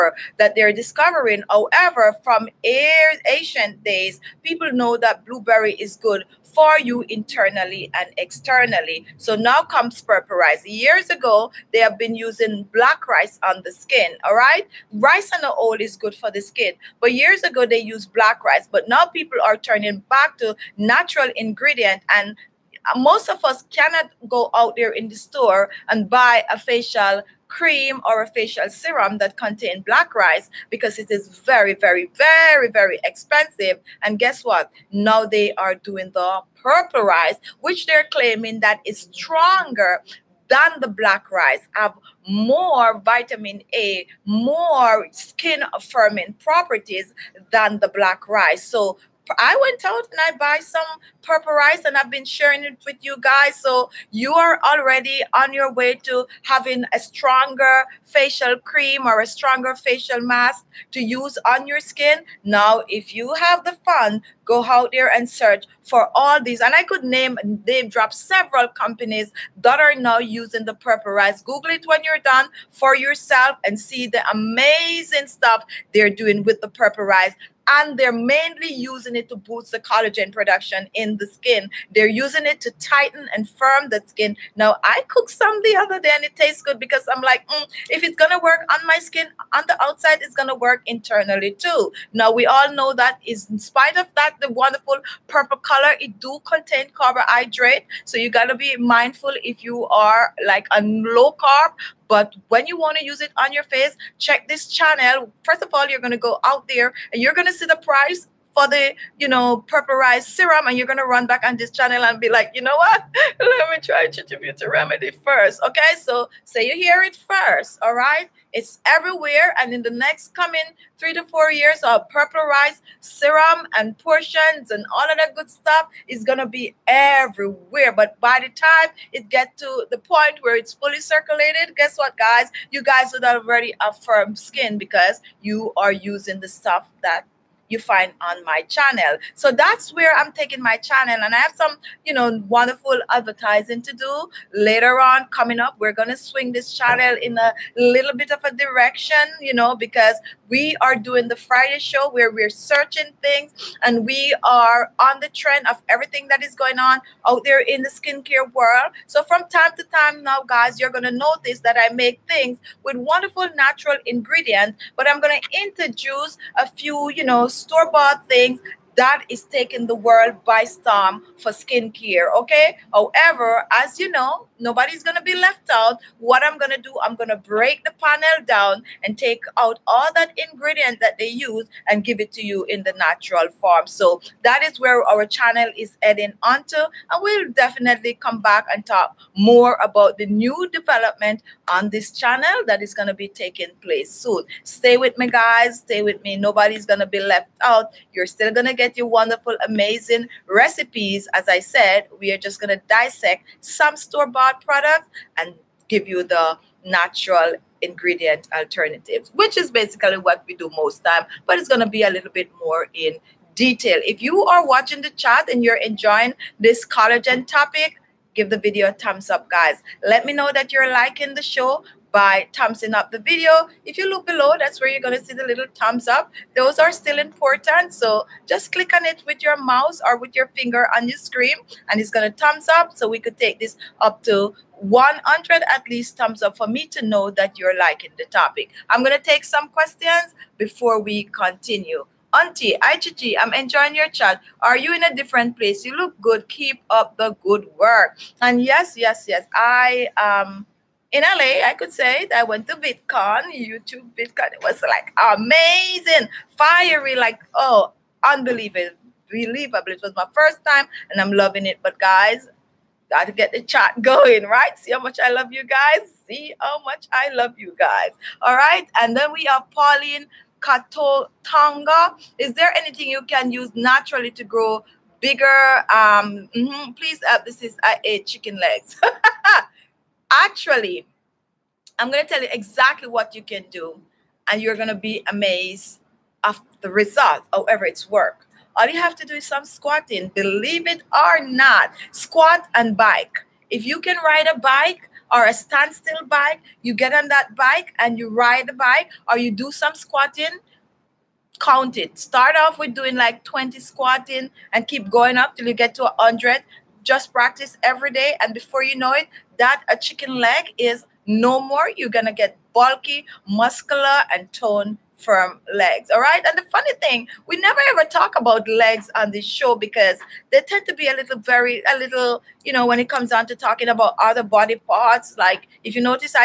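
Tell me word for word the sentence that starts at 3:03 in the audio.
So that is where our channel is heading onto.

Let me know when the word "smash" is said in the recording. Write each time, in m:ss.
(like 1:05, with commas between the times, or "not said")
not said.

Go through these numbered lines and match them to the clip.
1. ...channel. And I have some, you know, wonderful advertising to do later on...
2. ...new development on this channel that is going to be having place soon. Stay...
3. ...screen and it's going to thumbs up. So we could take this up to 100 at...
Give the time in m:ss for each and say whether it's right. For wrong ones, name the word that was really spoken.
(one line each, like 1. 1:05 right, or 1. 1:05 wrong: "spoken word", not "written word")
1. 2:20 right
2. 3:10 wrong: "taking", not "having"
3. 3:51 right.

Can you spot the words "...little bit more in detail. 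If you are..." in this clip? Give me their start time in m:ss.
3:32.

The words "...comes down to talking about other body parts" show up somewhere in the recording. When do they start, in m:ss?
5:23.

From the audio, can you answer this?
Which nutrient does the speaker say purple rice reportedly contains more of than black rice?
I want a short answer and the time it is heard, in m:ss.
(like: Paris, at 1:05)
Vitamin A, at 0:43.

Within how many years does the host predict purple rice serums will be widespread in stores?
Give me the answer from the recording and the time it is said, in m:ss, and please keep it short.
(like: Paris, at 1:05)
3 to 4, at 2:00.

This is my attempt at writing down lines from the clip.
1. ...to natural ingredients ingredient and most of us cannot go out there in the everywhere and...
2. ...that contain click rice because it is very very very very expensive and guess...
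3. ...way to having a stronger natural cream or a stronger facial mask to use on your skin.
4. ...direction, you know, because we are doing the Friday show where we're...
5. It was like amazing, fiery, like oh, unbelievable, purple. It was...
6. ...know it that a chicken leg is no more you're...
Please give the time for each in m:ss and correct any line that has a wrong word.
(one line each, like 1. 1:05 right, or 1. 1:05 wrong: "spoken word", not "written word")
1. 0:20 wrong: "store", not "everywhere"
2. 0:29 wrong: "black", not "click"
3. 0:55 wrong: "facial", not "natural"
4. 2:28 right
5. 4:14 wrong: "believable", not "purple"
6. 5:08 right.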